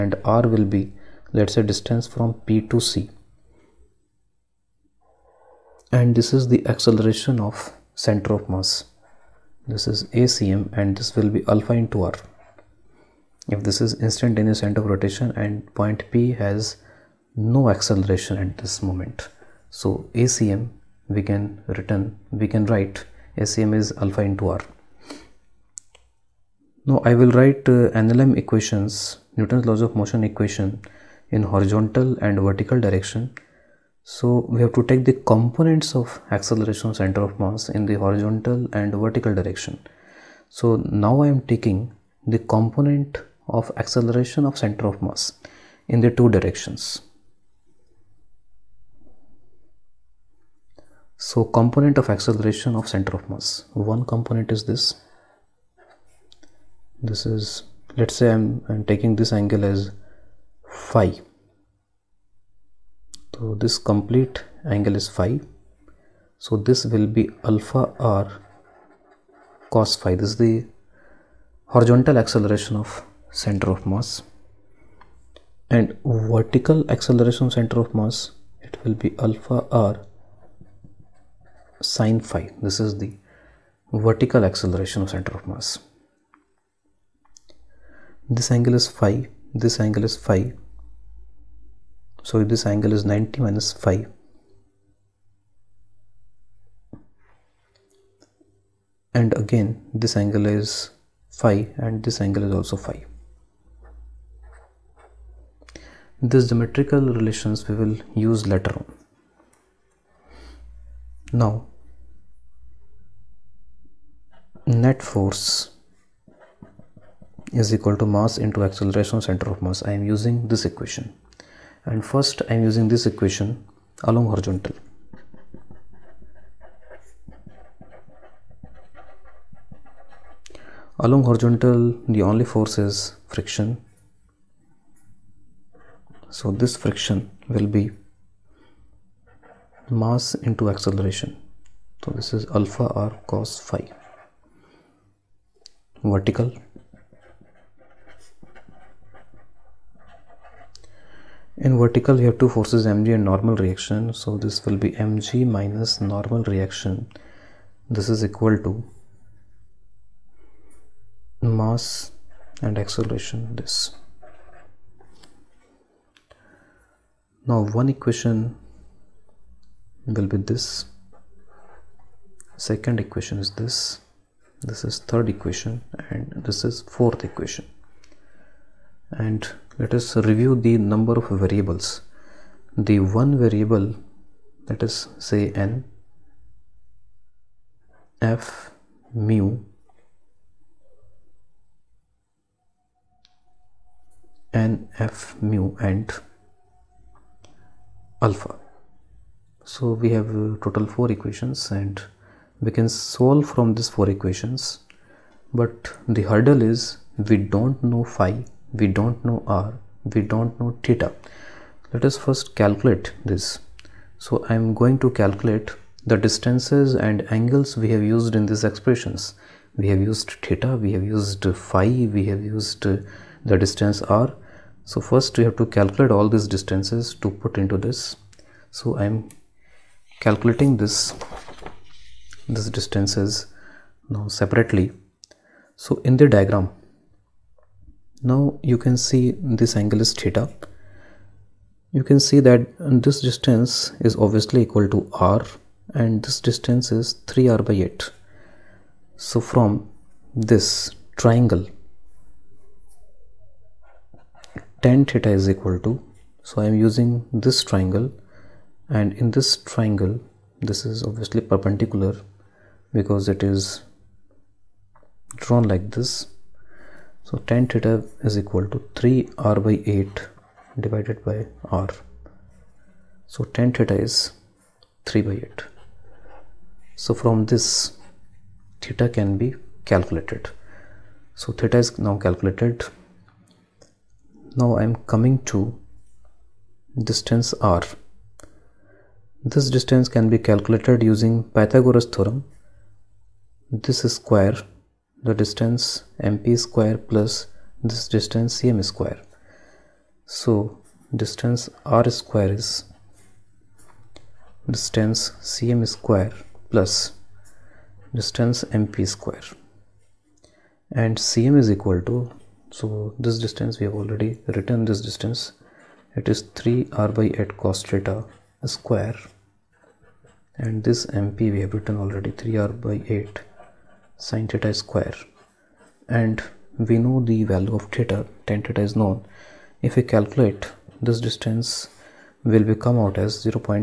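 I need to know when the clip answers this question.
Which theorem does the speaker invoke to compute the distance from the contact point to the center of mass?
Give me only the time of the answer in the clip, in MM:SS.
04:51.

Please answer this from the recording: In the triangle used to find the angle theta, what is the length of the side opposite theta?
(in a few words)
3r/8.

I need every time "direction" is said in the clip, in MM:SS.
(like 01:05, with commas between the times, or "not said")
00:32, 00:39, 00:46.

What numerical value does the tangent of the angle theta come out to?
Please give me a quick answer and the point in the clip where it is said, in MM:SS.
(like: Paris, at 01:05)
3/8, at 04:35.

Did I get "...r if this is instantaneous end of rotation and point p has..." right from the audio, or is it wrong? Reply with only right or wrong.
right.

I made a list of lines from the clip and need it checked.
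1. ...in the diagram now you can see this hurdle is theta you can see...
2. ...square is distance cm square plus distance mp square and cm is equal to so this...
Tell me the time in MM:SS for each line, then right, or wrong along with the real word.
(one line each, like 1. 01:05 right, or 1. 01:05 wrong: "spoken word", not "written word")
1. 03:56 wrong: "angle", not "hurdle"
2. 05:02 right.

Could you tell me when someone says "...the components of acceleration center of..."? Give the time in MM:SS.
00:35.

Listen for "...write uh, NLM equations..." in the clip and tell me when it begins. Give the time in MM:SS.
00:27.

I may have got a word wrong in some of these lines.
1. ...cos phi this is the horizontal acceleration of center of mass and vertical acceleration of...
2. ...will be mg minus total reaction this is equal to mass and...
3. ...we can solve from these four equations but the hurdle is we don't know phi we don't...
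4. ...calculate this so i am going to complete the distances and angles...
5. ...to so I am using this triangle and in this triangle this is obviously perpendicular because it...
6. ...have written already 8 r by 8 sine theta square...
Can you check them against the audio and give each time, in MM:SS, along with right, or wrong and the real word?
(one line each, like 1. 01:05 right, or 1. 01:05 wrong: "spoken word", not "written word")
1. 01:09 right
2. 02:34 wrong: "normal", not "total"
3. 03:22 right
4. 03:32 wrong: "calculate", not "complete"
5. 04:15 right
6. 05:21 wrong: "3", not "8".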